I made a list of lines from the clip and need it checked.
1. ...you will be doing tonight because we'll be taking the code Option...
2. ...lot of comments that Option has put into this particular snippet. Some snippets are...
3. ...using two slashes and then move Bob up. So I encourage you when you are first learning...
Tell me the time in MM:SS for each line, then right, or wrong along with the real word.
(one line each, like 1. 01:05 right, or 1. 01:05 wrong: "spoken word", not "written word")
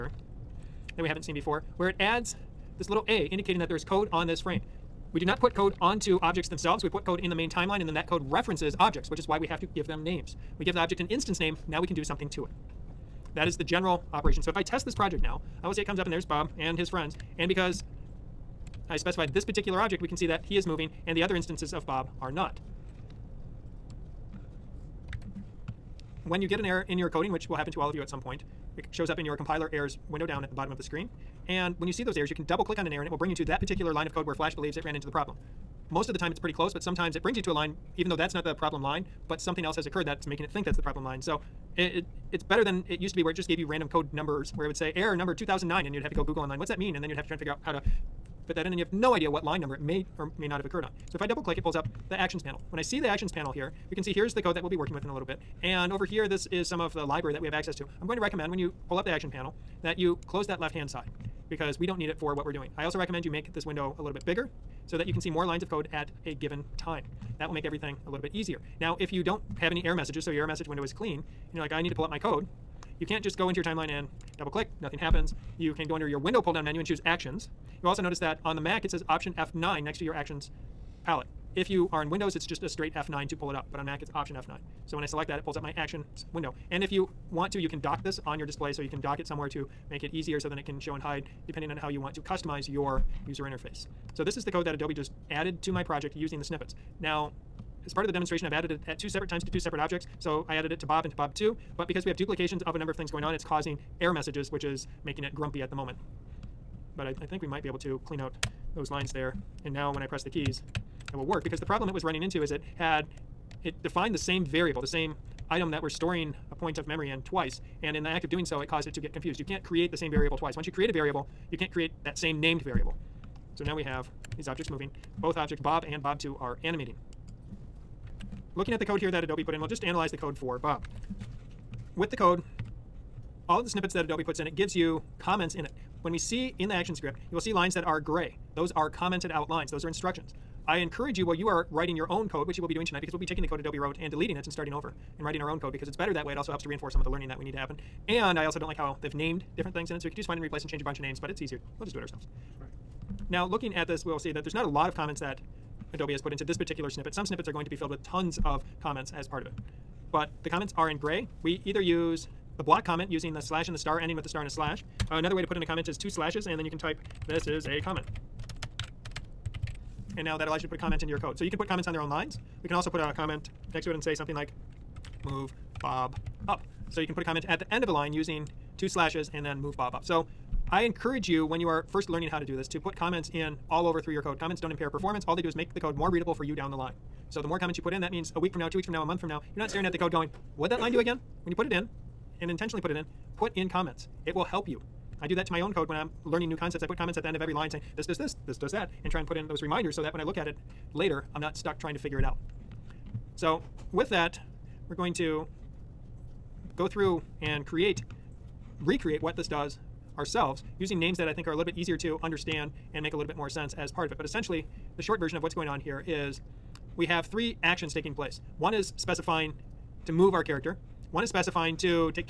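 1. 02:22 wrong: "Adobe", not "Option"
2. 02:34 wrong: "Adobe", not "Option"
3. 02:58 right.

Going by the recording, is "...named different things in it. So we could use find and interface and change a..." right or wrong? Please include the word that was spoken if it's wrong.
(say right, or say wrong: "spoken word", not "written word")
wrong: "replace", not "interface".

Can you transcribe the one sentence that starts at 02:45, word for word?
Uh, another way to put in a comment is two slashes, and then you can type, this is a comment.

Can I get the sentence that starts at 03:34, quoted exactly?
But essentially, the short version of what's going on here is we have three actions taking place.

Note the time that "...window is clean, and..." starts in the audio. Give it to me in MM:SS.
01:10.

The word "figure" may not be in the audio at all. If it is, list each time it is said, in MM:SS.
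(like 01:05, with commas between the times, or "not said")
00:47, 03:21.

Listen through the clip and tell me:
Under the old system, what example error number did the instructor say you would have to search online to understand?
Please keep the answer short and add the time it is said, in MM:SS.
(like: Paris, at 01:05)
2009, at 00:44.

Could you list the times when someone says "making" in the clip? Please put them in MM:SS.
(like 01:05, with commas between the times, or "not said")
00:40, 01:45.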